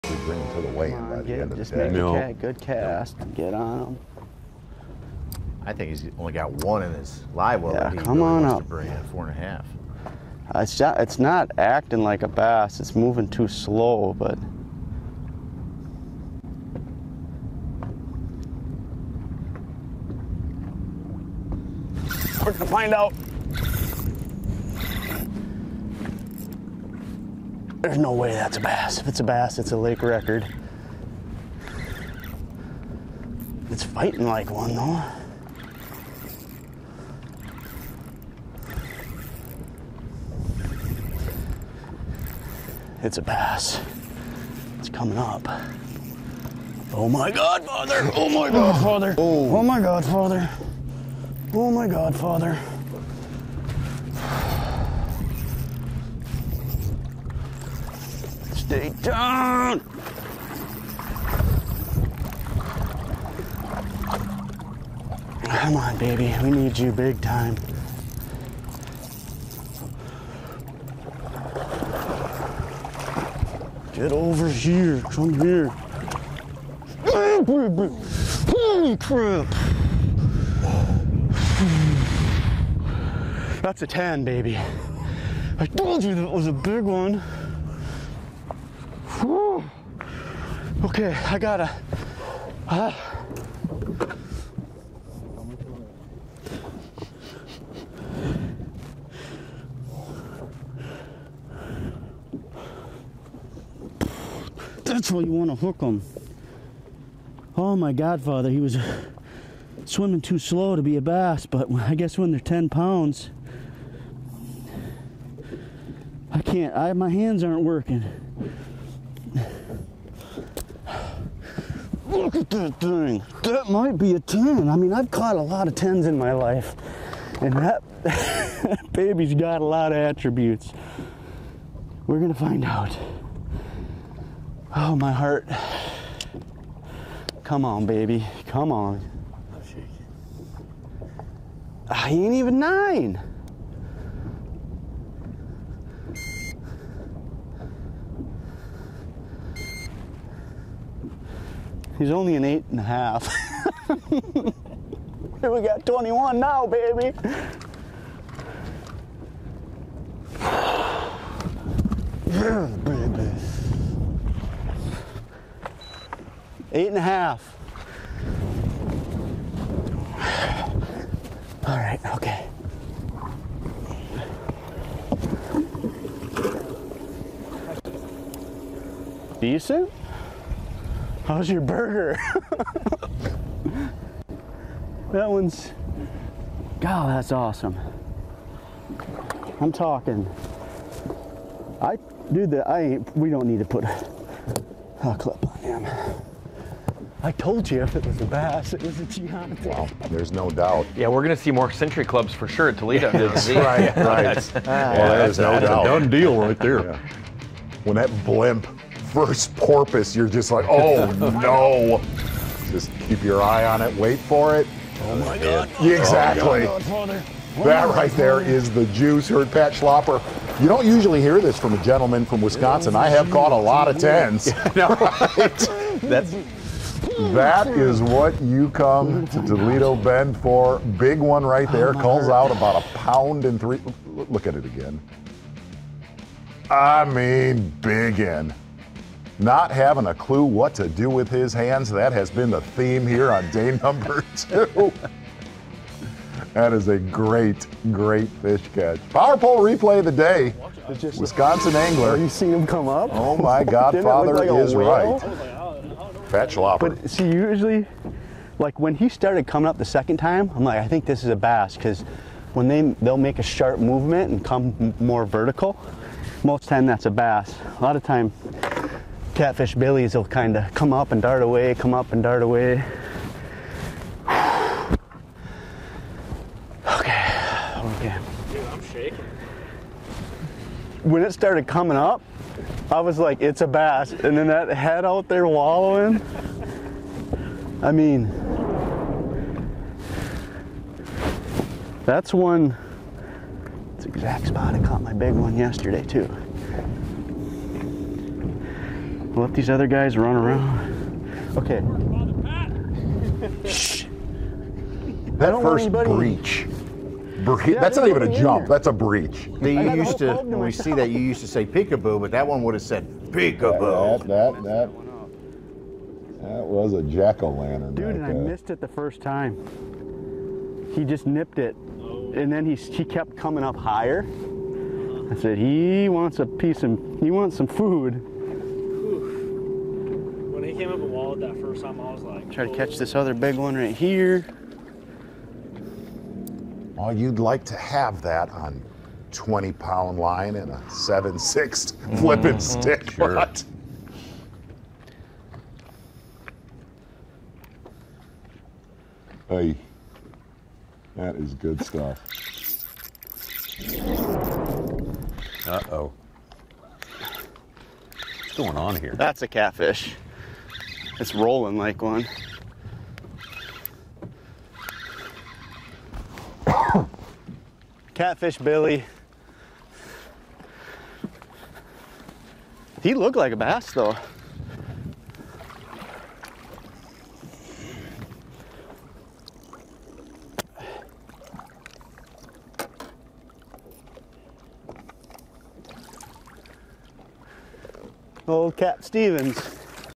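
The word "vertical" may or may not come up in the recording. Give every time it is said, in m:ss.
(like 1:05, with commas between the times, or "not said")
4:25.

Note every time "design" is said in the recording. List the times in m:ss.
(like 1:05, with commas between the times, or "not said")
not said.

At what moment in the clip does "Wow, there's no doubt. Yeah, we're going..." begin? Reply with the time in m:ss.
3:19.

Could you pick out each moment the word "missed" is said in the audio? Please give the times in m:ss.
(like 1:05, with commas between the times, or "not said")
5:18.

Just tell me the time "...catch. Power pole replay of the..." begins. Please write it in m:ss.
4:08.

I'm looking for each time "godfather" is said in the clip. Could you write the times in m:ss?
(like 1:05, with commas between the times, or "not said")
1:47, 4:13.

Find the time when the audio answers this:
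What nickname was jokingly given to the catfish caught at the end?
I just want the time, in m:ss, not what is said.
6:28.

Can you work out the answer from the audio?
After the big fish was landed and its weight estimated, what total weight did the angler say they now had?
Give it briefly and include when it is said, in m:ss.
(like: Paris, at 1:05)
21, at 2:35.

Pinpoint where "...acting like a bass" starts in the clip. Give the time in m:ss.
0:11.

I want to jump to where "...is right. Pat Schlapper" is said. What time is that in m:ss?
4:14.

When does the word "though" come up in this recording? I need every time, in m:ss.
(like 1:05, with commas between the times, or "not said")
0:34, 6:13.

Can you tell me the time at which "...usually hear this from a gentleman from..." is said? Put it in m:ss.
3:40.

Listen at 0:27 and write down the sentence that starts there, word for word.
There's no way that's a bass.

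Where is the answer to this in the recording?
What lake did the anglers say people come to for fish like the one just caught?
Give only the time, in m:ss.
3:49.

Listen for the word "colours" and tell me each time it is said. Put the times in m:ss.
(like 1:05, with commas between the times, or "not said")
not said.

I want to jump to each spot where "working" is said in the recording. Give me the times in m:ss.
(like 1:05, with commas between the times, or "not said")
1:57.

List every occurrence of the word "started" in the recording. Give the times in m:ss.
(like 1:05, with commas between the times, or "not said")
4:19, 4:41.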